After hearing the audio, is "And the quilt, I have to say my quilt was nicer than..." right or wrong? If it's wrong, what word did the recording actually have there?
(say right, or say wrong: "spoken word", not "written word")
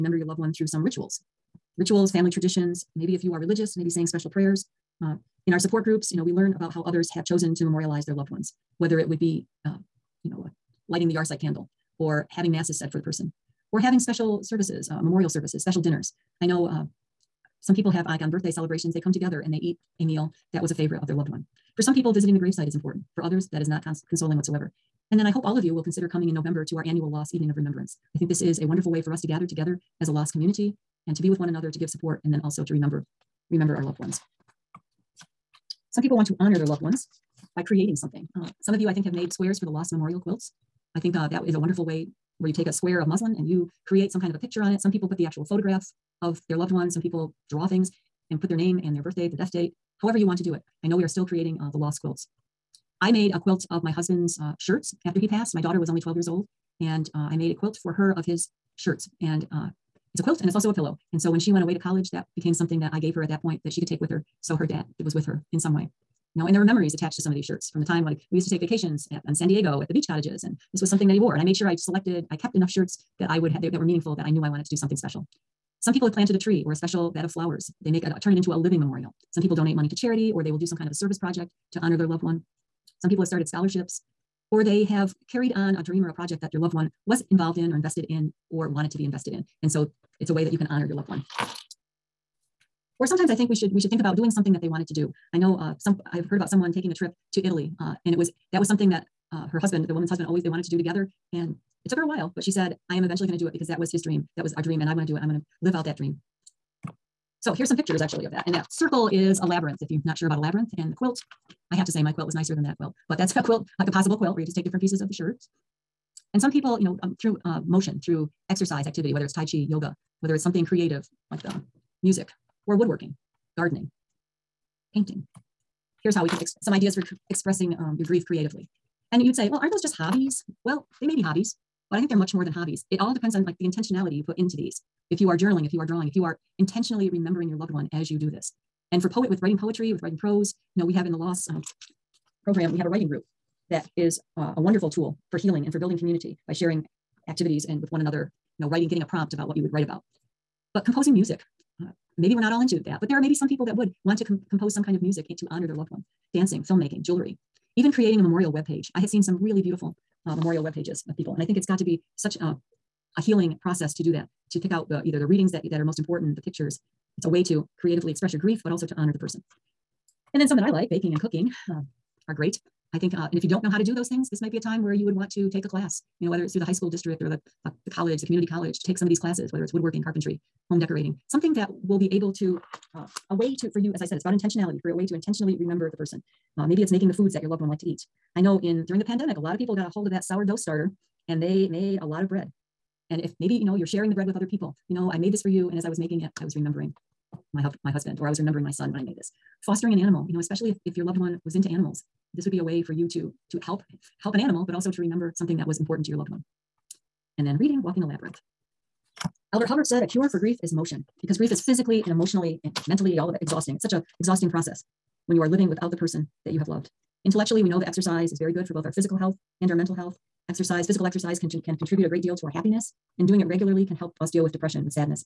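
right.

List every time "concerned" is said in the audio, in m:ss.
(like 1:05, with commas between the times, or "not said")
not said.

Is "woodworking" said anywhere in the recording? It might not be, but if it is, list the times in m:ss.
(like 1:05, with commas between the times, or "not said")
2:02, 2:59.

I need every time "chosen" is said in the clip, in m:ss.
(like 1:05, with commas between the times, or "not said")
0:07.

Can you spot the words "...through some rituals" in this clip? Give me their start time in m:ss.
0:00.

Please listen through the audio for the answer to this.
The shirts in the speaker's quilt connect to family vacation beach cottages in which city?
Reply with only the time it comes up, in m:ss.
1:09.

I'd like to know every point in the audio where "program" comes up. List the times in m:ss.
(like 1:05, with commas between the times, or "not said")
2:22.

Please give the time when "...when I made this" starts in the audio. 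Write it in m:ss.
3:18.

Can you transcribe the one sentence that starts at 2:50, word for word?
And then some that I like, baking and cooking, uh, are great.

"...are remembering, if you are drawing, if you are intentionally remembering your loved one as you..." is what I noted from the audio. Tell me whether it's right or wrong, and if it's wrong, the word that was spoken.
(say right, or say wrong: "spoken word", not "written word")
wrong: "journaling", not "remembering".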